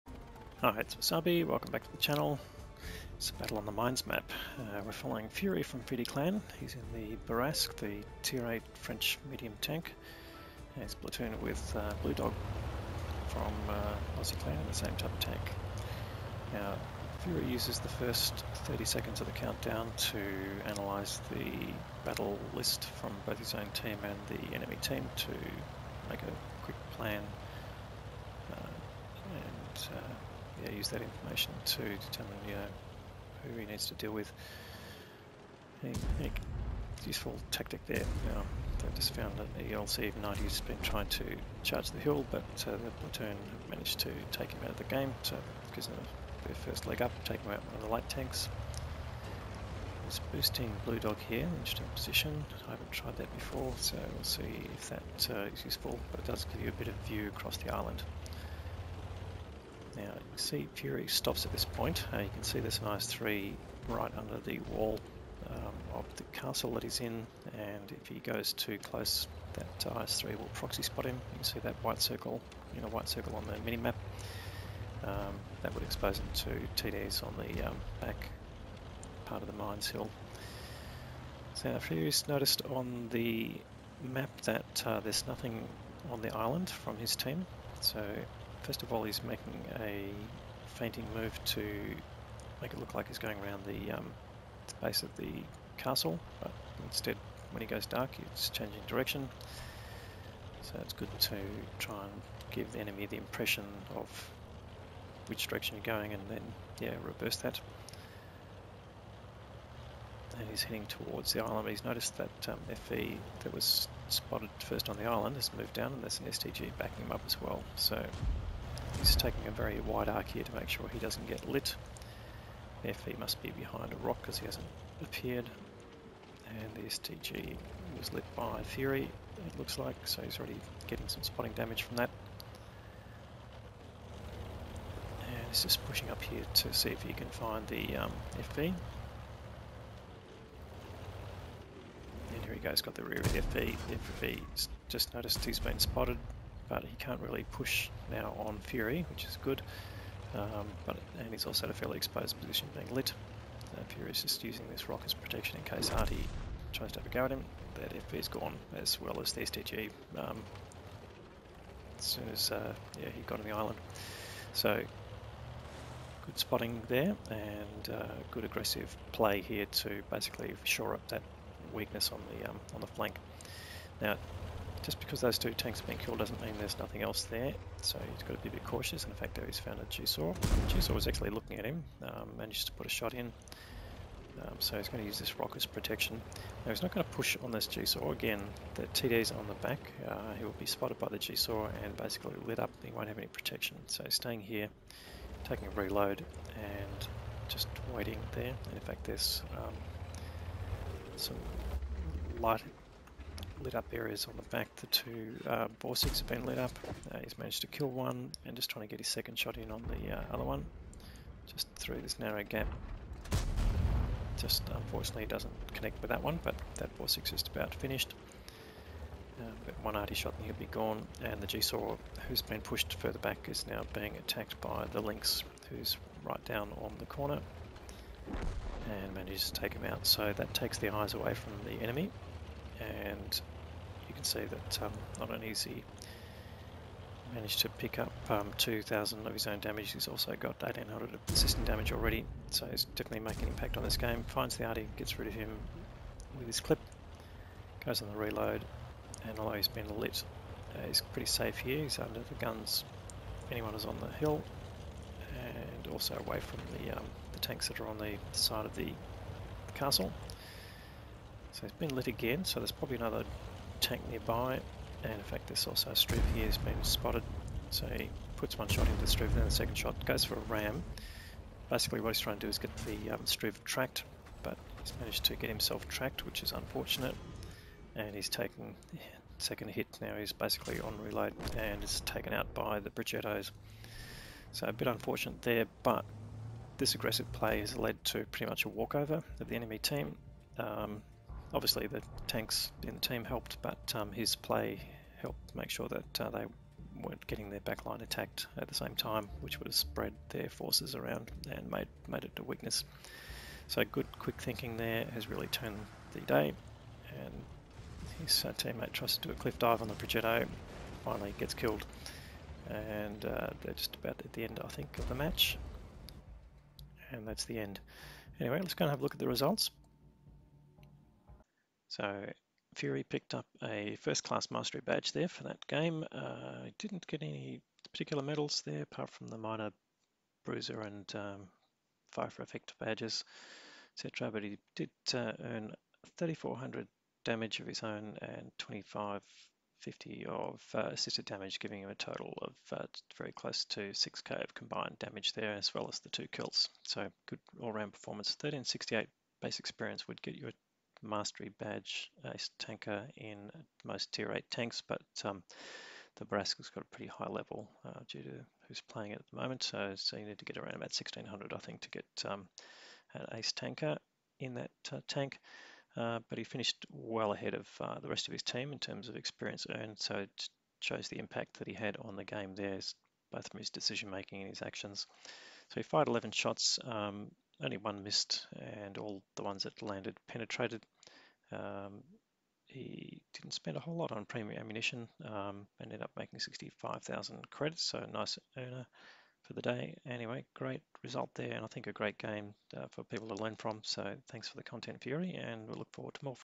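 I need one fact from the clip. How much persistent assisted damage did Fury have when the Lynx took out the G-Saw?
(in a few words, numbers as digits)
1,800.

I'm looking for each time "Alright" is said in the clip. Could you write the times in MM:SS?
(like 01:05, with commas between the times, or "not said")
00:00.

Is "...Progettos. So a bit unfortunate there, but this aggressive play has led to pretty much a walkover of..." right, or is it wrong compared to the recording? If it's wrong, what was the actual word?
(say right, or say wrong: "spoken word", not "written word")
right.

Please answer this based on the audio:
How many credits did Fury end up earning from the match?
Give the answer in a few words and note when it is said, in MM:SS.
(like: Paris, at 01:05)
65,000, at 06:26.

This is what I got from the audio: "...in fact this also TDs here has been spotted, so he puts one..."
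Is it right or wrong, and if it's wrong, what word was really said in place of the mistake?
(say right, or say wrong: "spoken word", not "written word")
wrong: "Struve", not "TDs".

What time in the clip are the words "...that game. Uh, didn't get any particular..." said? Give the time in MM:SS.
05:25.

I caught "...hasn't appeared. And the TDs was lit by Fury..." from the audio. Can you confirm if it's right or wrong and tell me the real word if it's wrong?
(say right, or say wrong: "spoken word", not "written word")
wrong: "STG", not "TDs".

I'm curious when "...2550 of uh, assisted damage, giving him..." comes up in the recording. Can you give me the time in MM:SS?
05:38.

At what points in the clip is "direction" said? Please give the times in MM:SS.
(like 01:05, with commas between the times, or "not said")
01:38, 01:45.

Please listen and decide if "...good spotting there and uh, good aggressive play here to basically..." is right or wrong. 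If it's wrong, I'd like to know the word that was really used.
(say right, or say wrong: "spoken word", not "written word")
right.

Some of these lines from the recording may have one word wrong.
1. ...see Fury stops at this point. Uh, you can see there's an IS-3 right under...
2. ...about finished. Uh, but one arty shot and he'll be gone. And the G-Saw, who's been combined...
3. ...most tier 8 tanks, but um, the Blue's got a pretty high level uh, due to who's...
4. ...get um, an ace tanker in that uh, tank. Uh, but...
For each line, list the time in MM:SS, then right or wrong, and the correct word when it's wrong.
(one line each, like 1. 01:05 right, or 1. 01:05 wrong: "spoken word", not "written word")
1. 01:00 right
2. 03:37 wrong: "pushed", not "combined"
3. 05:53 wrong: "Bourrasque", not "Blue"
4. 06:01 right.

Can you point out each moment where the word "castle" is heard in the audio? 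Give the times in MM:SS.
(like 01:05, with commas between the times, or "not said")
01:06, 01:35, 04:19.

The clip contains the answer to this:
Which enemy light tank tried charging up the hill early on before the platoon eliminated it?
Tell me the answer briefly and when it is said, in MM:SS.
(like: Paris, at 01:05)
LCV-90, at 00:39.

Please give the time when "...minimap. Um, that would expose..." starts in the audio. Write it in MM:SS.
01:13.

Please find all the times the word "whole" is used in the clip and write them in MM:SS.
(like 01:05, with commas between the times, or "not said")
06:23.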